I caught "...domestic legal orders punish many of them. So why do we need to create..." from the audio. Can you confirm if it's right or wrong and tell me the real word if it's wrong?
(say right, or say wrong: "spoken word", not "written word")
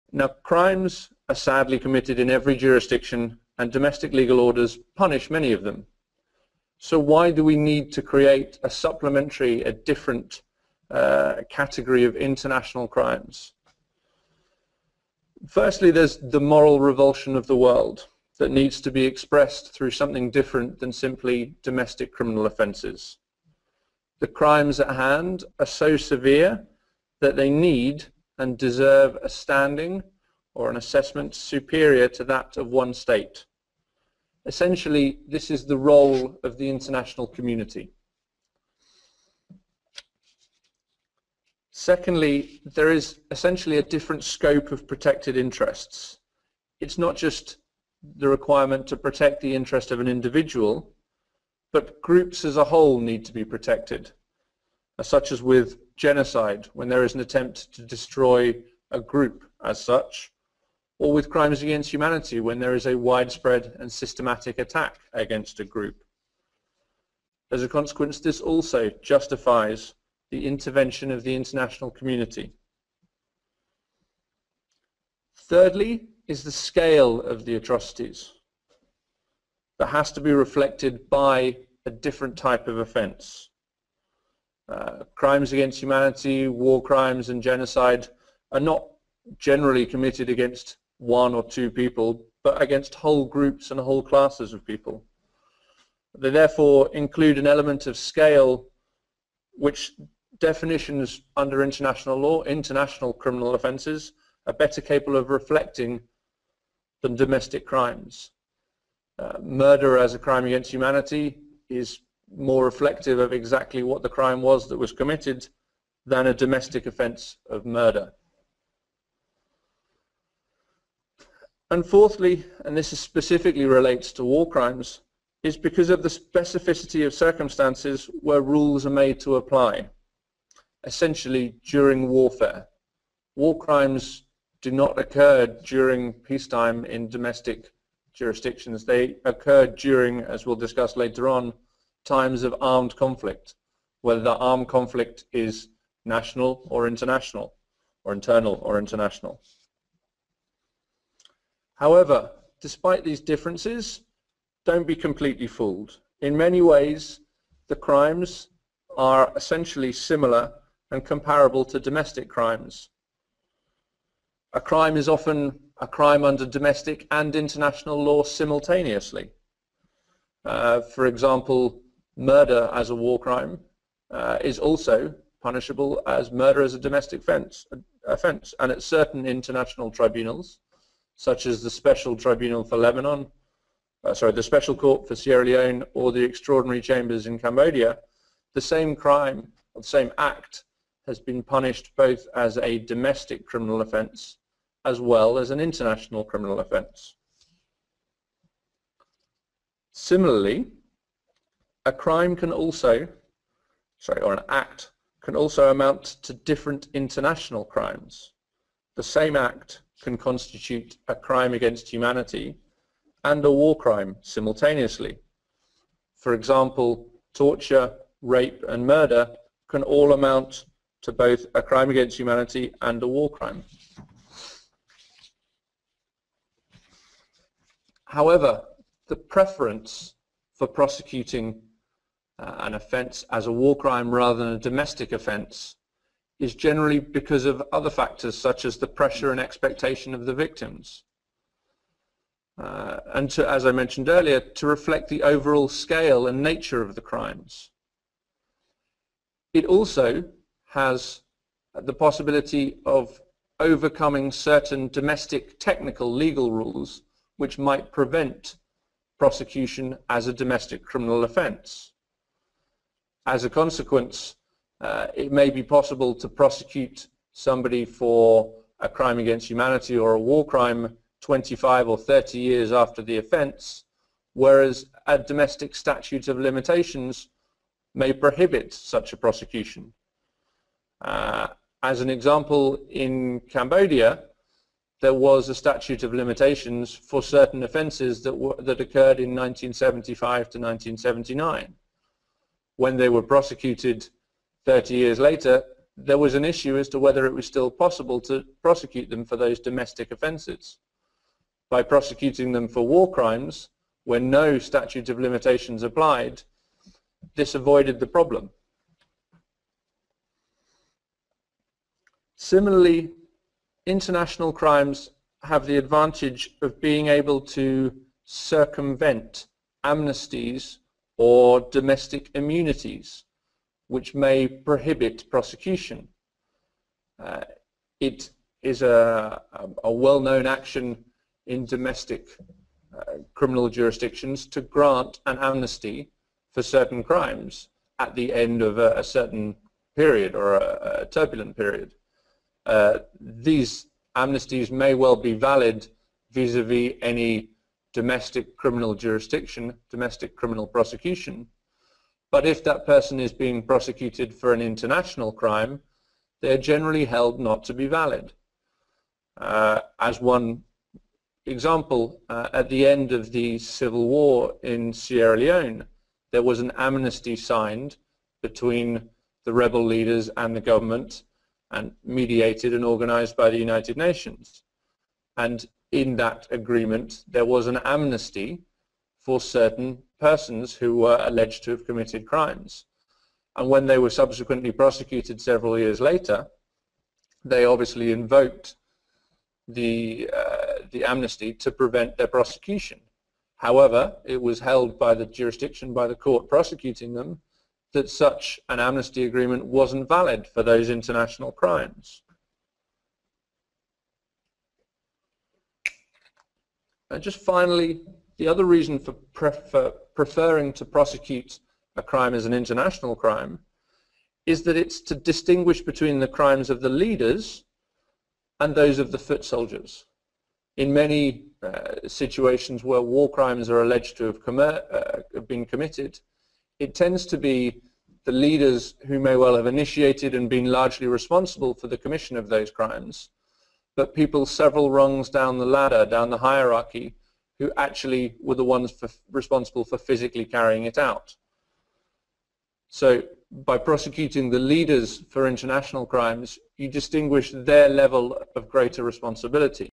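right.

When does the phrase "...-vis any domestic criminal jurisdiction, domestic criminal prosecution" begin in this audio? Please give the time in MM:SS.
05:46.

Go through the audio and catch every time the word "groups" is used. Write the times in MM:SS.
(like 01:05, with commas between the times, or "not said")
00:52, 00:58, 01:05, 01:33.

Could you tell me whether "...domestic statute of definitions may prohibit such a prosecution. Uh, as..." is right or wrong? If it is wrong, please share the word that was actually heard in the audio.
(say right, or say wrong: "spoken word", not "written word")
wrong: "limitations", not "definitions".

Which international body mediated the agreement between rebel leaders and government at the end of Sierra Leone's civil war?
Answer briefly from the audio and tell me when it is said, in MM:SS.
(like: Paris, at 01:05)
United Nations, at 06:13.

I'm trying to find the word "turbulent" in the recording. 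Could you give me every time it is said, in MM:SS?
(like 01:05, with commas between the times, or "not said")
05:41.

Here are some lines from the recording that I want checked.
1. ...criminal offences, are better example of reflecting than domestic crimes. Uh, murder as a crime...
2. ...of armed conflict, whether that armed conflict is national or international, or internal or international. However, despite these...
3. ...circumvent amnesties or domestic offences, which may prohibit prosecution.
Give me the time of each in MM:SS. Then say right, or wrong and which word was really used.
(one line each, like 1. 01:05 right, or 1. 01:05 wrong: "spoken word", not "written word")
1. 01:43 wrong: "capable", not "example"
2. 02:22 right
3. 05:18 wrong: "immunities", not "offences".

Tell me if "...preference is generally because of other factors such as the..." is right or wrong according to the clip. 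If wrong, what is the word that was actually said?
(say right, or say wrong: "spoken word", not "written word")
wrong: "offence", not "preference".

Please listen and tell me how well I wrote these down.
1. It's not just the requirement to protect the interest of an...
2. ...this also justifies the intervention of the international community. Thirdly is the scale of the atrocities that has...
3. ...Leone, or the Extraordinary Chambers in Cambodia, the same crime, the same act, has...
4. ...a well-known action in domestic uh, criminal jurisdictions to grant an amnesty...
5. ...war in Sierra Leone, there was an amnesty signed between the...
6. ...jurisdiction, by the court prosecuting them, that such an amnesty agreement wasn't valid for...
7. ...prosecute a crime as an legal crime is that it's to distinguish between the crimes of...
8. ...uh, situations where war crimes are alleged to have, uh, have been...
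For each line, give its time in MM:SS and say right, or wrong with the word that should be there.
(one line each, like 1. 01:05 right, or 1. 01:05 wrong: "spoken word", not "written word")
1. 00:46 right
2. 01:08 right
3. 03:05 right
4. 05:29 right
5. 06:04 right
6. 06:35 right
7. 06:50 wrong: "international", not "legal"
8. 07:01 right.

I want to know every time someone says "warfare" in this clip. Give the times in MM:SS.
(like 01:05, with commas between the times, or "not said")
02:12.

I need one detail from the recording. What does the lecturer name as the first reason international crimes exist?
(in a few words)
Moral revulsion.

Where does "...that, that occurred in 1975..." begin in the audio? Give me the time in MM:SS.
04:48.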